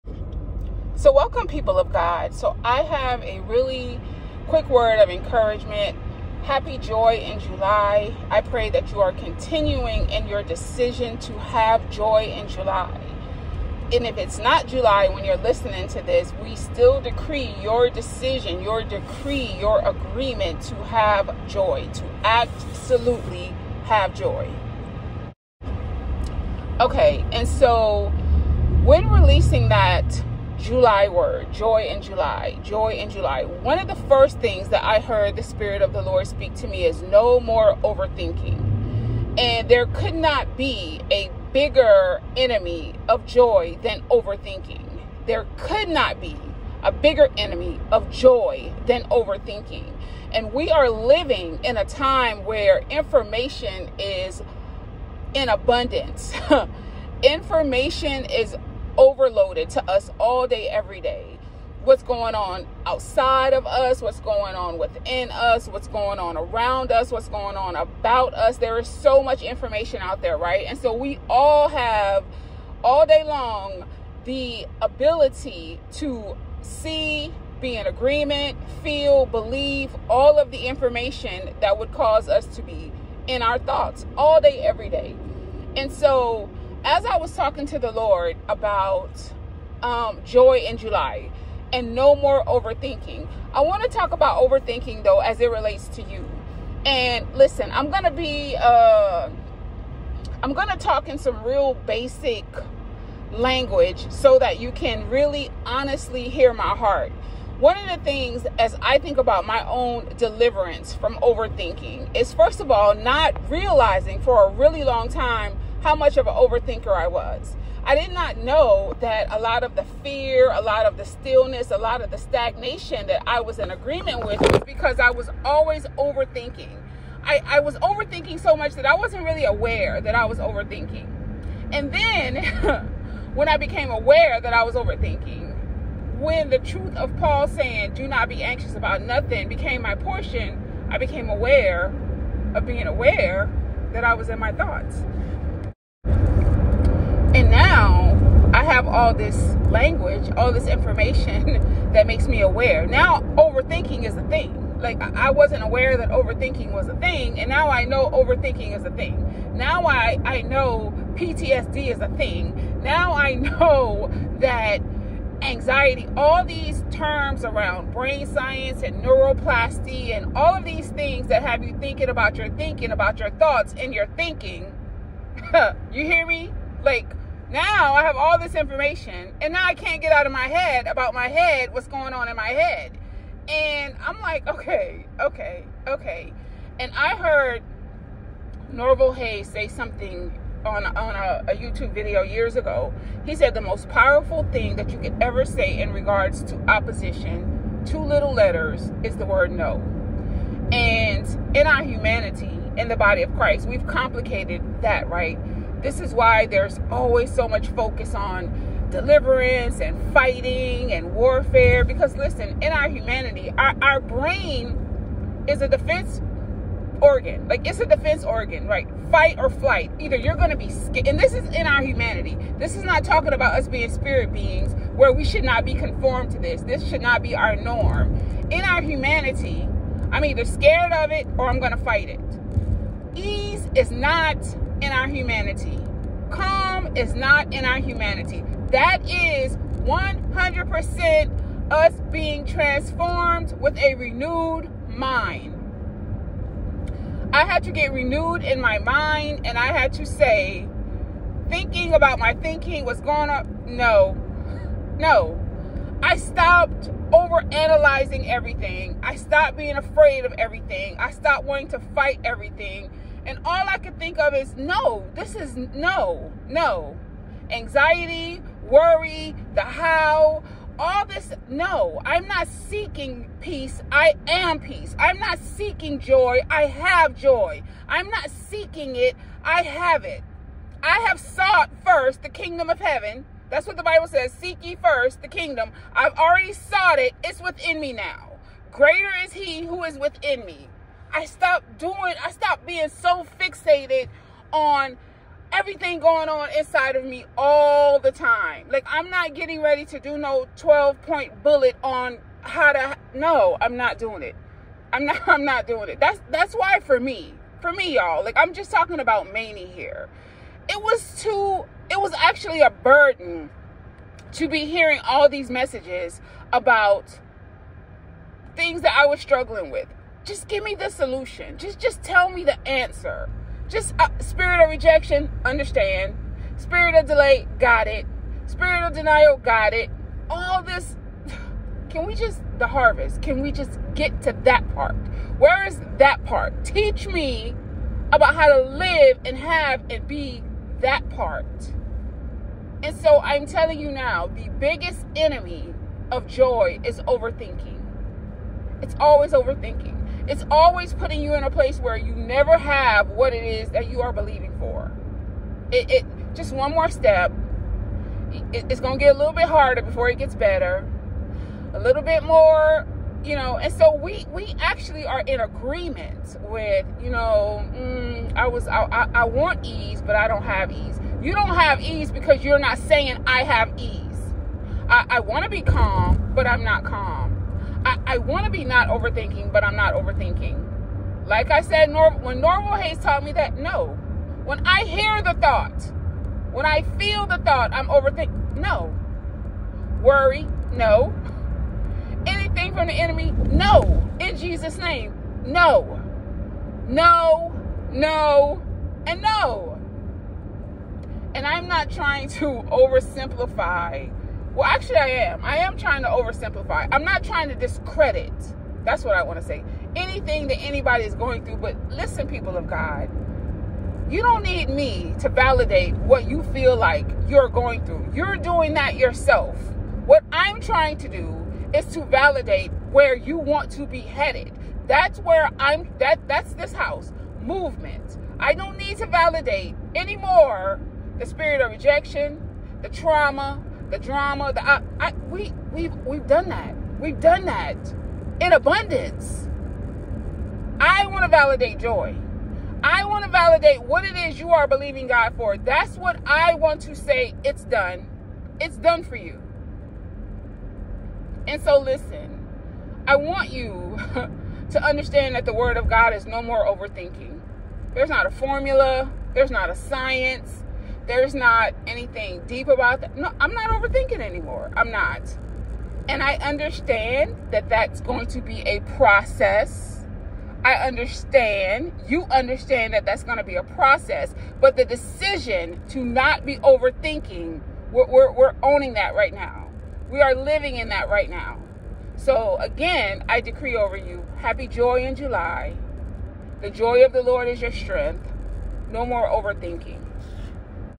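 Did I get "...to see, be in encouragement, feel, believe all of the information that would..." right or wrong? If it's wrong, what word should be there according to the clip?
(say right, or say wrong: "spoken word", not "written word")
wrong: "agreement", not "encouragement".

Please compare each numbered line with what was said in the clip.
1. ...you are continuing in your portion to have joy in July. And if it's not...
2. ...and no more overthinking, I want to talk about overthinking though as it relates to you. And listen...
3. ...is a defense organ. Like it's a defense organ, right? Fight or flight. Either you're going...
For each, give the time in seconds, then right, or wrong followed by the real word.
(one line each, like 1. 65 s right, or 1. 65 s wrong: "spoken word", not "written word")
1. 8 s wrong: "decision", not "portion"
2. 91 s right
3. 215 s right.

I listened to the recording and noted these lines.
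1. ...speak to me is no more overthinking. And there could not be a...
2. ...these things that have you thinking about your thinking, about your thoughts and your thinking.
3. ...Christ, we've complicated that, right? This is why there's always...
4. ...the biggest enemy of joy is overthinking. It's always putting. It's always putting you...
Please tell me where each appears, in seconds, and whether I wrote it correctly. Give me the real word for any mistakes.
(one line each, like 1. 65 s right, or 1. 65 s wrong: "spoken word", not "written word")
1. 36 s right
2. 170 s right
3. 203 s right
4. 344 s wrong: "overthinking", not "putting".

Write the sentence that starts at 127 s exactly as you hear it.
I, I was overthinking so much that I wasn't really aware that I was overthinking.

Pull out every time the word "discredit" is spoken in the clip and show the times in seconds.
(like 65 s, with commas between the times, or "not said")
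407 s.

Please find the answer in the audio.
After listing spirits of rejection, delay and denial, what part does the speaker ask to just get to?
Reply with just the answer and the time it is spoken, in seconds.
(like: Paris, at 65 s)
the harvest, at 332 s.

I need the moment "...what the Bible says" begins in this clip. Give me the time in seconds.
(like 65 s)
283 s.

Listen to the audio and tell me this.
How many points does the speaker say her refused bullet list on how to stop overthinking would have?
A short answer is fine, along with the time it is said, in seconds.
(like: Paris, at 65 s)
12, at 300 s.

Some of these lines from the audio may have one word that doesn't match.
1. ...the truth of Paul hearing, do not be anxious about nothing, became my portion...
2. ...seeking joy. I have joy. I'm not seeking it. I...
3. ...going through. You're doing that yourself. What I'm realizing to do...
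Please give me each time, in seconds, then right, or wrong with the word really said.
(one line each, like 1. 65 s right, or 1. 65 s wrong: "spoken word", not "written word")
1. 136 s wrong: "saying", not "hearing"
2. 275 s right
3. 417 s wrong: "trying", not "realizing".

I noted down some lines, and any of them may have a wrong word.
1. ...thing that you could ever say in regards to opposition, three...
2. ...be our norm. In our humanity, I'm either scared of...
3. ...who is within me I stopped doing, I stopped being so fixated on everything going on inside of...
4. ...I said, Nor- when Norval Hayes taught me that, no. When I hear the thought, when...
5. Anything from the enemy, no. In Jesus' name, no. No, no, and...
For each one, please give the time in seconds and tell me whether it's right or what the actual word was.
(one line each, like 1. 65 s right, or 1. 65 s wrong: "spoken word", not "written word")
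1. 194 s wrong: "two", not "three"
2. 227 s right
3. 289 s right
4. 381 s right
5. 392 s right.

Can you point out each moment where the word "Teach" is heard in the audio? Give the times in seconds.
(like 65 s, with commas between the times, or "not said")
336 s.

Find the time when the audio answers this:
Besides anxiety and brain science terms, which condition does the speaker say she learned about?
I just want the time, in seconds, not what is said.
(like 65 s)
161 s.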